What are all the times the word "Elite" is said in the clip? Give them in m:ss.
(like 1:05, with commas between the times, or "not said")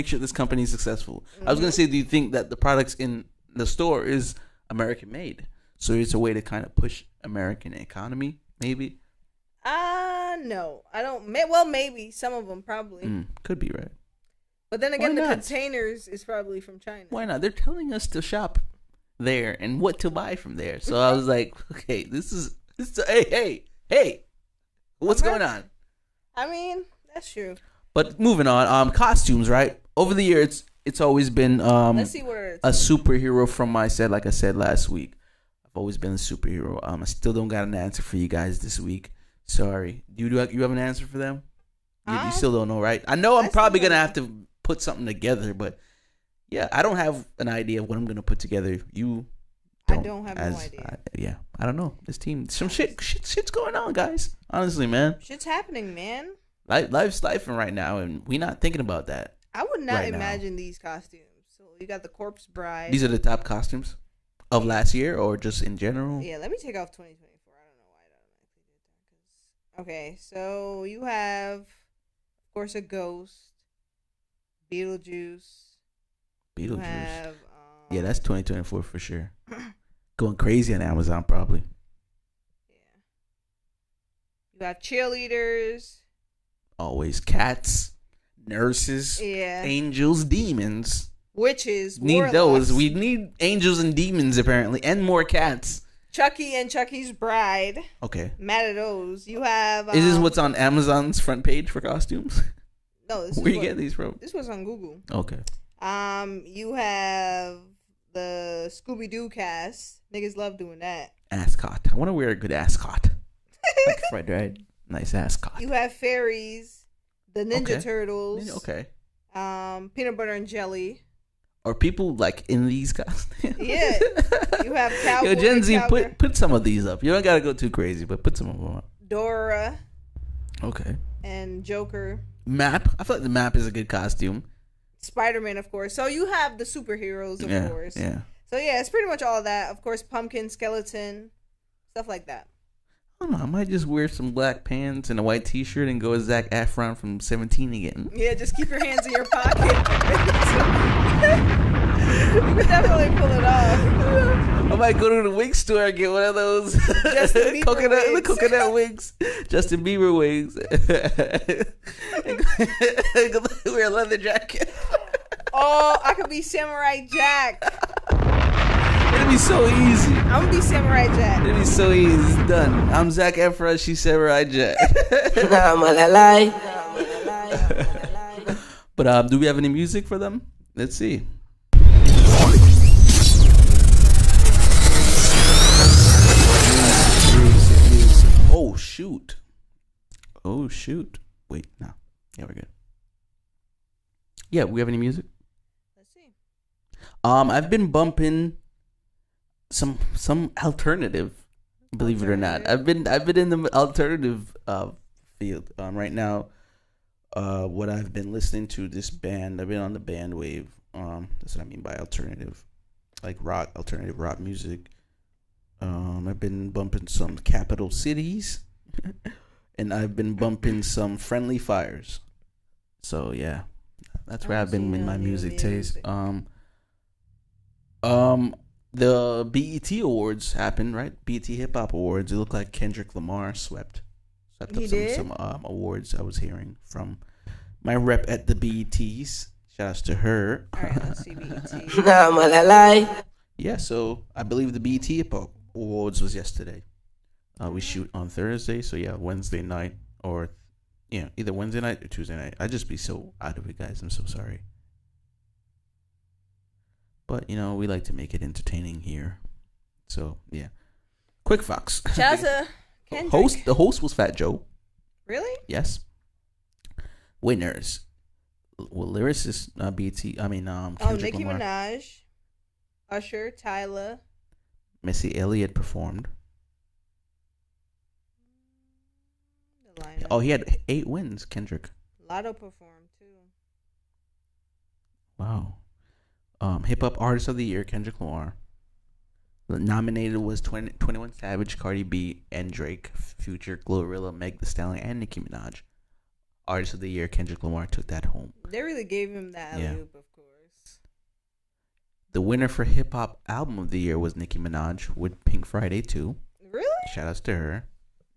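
not said.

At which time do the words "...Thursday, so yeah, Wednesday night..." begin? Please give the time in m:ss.
4:08.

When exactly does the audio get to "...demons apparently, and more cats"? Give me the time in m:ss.
1:33.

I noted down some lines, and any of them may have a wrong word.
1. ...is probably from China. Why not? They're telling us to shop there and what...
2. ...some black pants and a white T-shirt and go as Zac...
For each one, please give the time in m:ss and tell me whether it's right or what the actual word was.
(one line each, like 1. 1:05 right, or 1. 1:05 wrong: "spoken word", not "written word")
1. 0:16 right
2. 2:24 right.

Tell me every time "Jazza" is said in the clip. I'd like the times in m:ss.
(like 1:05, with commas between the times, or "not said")
4:22.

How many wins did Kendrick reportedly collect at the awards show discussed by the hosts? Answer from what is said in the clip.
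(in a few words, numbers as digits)
8.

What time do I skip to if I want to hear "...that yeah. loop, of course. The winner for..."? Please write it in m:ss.
4:59.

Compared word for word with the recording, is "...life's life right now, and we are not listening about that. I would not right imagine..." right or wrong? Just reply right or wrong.
wrong.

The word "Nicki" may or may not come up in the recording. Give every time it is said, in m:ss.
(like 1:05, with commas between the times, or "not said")
4:31, 4:55, 5:04.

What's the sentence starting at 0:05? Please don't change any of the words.
So it's a way to kind of push American economy, maybe.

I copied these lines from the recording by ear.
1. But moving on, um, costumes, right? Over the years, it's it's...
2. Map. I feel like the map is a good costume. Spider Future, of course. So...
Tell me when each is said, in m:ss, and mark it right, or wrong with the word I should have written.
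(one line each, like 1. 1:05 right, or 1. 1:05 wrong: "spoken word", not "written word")
1. 0:27 right
2. 2:12 wrong: "Man", not "Future".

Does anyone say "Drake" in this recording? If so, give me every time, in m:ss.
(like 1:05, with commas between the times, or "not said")
4:52.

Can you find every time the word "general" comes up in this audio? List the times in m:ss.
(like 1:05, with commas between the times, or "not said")
1:05.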